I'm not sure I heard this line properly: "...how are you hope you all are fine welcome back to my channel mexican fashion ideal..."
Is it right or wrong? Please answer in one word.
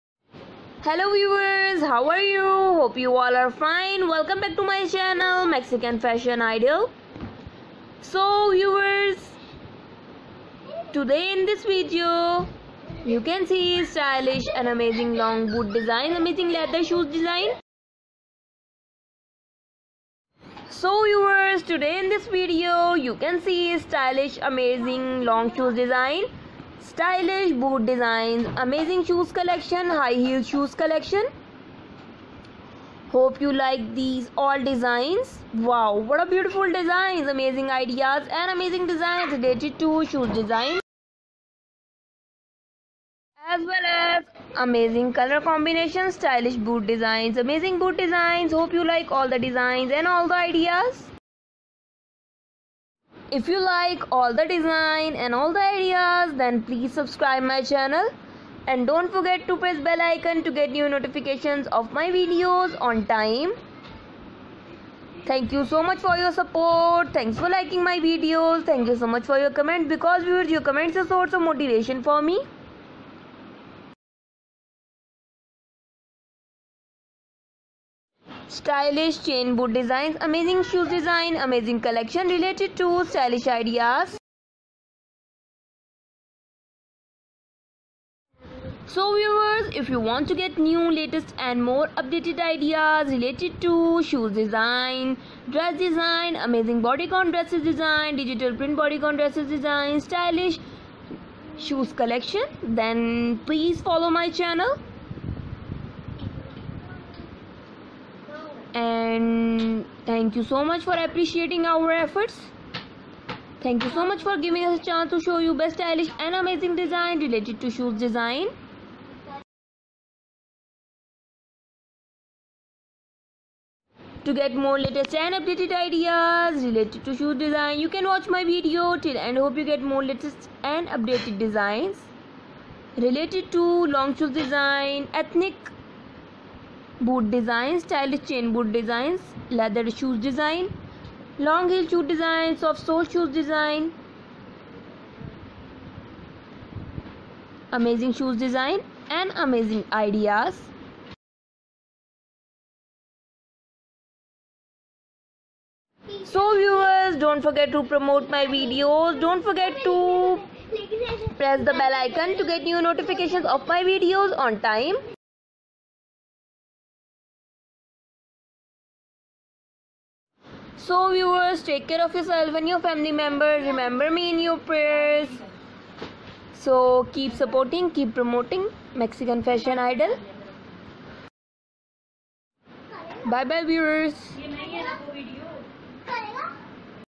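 right.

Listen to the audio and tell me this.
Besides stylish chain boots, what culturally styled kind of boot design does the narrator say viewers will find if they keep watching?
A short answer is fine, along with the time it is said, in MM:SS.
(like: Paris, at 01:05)
Ethnic boot, at 02:15.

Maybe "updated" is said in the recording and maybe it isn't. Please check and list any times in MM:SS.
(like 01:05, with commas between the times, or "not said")
01:31, 02:05, 02:10.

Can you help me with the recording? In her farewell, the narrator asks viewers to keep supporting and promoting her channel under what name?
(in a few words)
Mexican fashion idol.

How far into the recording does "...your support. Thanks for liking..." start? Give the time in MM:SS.
01:06.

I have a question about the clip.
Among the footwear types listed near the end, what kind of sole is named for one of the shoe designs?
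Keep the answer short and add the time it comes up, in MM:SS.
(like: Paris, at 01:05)
Soft sole, at 02:22.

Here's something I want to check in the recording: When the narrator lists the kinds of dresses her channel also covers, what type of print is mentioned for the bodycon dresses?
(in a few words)
Digital print.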